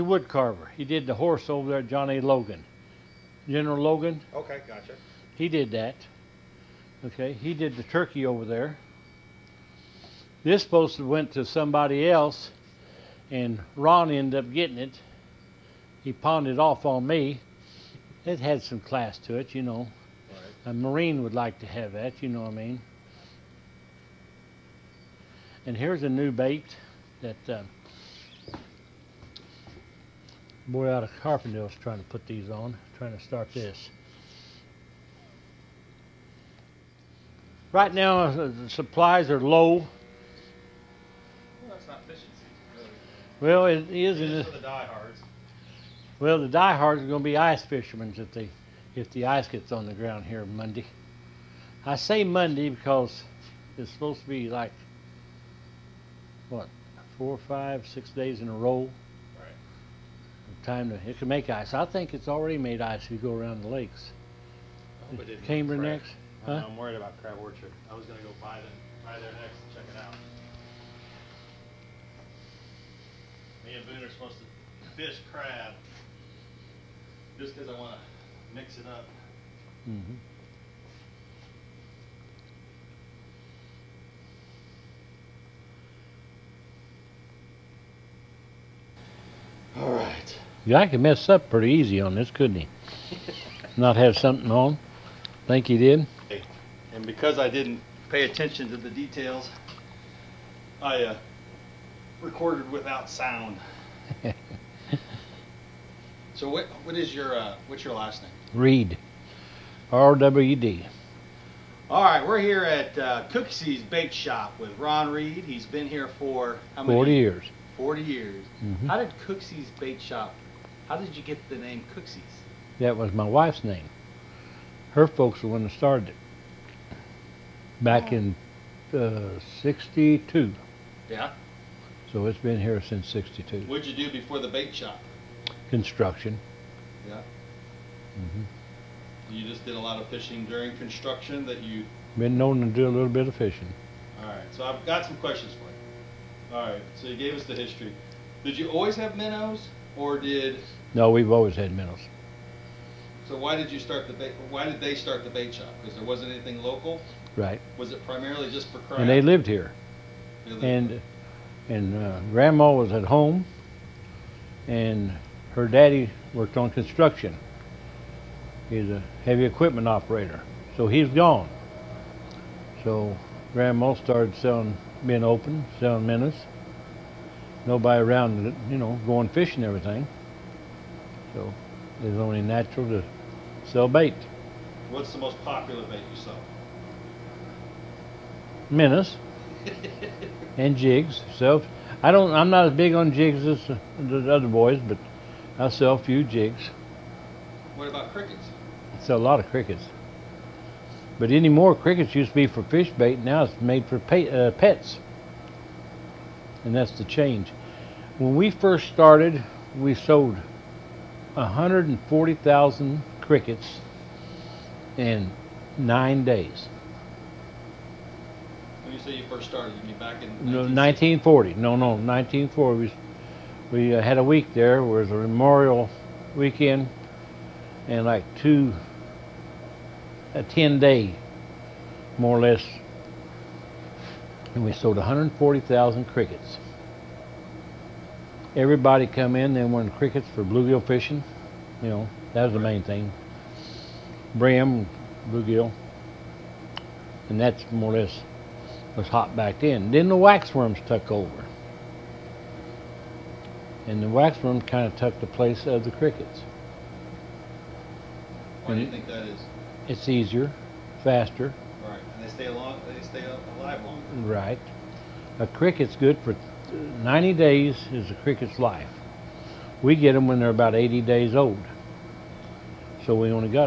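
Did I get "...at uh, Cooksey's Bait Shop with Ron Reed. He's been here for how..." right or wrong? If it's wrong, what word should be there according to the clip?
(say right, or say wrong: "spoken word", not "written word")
right.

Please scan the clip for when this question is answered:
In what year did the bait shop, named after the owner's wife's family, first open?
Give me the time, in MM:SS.
02:09.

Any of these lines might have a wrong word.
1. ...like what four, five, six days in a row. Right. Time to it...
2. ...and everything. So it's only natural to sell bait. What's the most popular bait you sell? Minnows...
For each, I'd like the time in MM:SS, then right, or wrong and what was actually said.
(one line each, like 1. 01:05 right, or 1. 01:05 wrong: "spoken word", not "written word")
1. 00:54 right
2. 02:59 right.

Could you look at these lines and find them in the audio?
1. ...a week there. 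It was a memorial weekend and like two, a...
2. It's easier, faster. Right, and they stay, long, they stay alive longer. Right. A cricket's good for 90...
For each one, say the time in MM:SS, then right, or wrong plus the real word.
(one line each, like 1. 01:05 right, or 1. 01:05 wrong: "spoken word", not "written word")
1. 03:44 right
2. 04:19 right.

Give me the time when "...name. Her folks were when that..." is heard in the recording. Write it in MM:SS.
02:03.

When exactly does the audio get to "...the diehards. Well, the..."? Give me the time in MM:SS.
00:44.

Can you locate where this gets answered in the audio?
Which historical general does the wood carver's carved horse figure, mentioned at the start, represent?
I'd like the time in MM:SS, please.
00:01.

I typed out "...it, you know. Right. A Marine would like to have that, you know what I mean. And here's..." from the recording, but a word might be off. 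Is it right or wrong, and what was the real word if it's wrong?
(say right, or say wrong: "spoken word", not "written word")
right.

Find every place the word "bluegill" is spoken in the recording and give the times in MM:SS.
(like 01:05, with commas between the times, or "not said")
04:00, 04:05.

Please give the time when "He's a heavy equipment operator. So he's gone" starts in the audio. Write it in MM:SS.
02:48.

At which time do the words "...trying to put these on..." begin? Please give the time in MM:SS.
00:31.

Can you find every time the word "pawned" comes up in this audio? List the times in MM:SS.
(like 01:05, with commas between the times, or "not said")
00:16.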